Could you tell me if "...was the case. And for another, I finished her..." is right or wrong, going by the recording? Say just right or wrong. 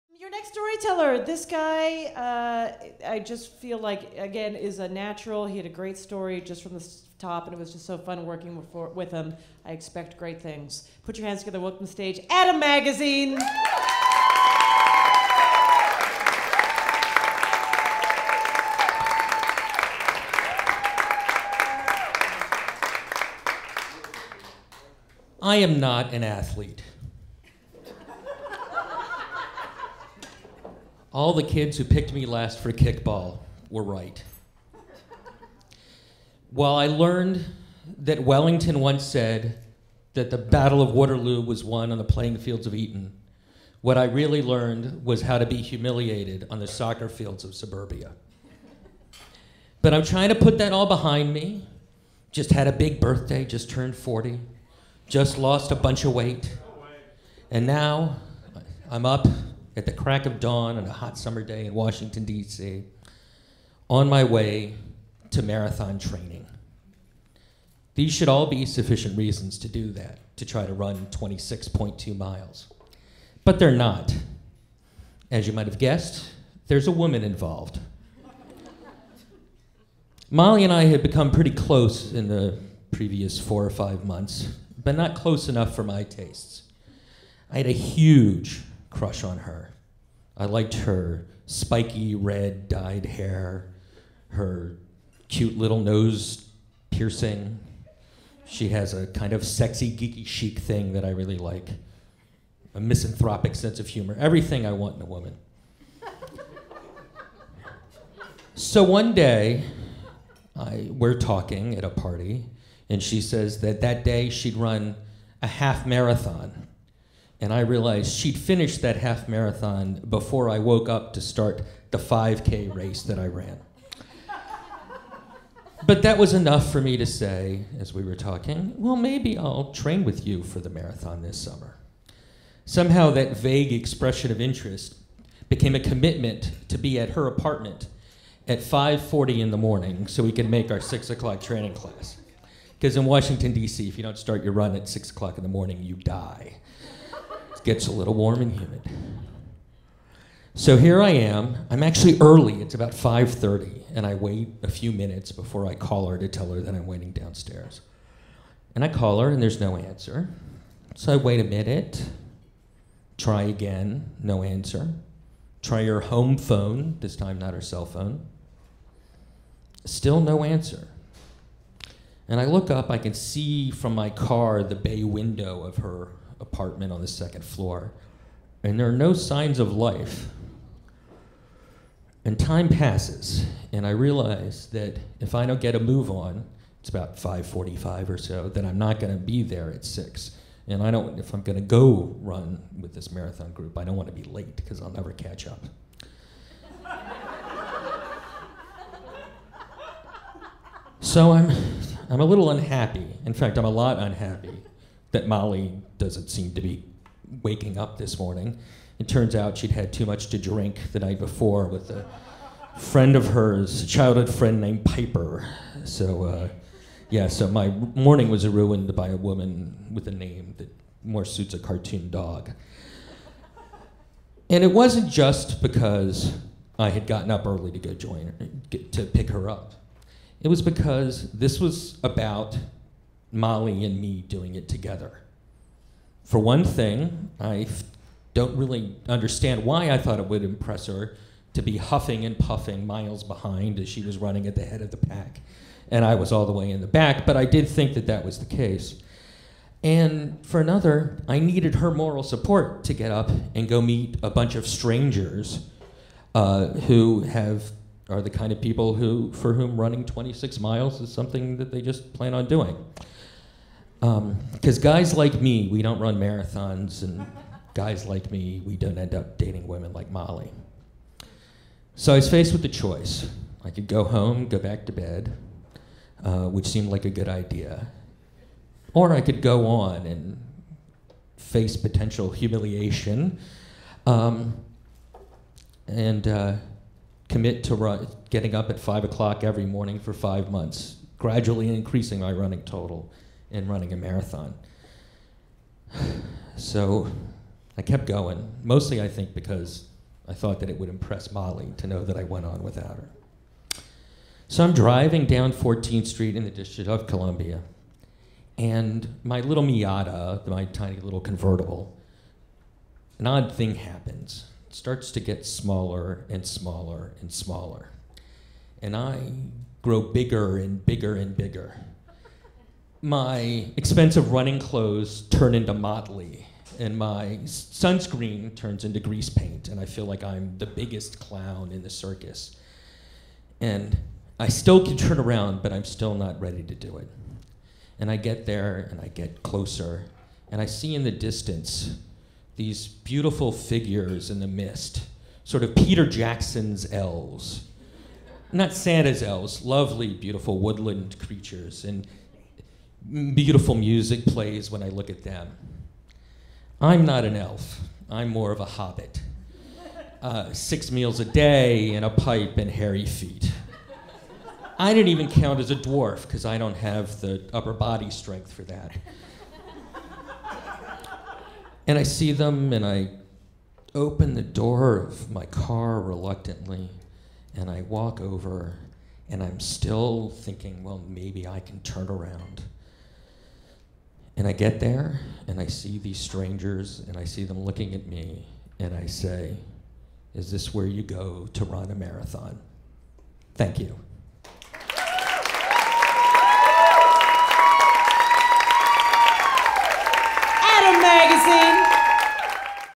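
wrong.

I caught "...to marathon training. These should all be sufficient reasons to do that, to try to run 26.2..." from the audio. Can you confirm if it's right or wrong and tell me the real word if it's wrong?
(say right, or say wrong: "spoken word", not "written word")
right.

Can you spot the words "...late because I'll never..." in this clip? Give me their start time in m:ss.
3:14.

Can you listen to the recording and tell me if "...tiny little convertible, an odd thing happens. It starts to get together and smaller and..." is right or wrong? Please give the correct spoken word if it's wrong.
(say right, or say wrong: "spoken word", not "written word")
wrong: "smaller", not "together".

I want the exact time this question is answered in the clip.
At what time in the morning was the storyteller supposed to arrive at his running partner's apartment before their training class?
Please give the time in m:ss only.
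2:18.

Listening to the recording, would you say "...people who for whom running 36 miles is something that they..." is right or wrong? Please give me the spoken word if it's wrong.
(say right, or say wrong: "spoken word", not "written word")
wrong: "26", not "36".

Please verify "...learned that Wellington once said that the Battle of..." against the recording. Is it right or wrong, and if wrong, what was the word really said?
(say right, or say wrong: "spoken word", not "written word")
right.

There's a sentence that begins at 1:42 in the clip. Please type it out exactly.
A misanthropic sense of humor, everything I want in a woman.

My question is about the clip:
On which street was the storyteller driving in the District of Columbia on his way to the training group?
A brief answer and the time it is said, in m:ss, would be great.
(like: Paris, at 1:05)
14th Street, at 5:05.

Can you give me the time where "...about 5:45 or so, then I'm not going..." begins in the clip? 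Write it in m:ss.
3:06.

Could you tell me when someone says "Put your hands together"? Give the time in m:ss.
0:11.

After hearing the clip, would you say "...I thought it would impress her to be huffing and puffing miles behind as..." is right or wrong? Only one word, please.
right.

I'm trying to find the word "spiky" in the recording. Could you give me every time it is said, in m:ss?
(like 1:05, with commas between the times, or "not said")
1:31.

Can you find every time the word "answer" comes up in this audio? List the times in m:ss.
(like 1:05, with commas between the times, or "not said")
2:39, 2:44, 2:50.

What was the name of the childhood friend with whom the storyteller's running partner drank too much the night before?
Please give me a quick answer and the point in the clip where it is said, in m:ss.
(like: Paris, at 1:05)
Piper, at 3:34.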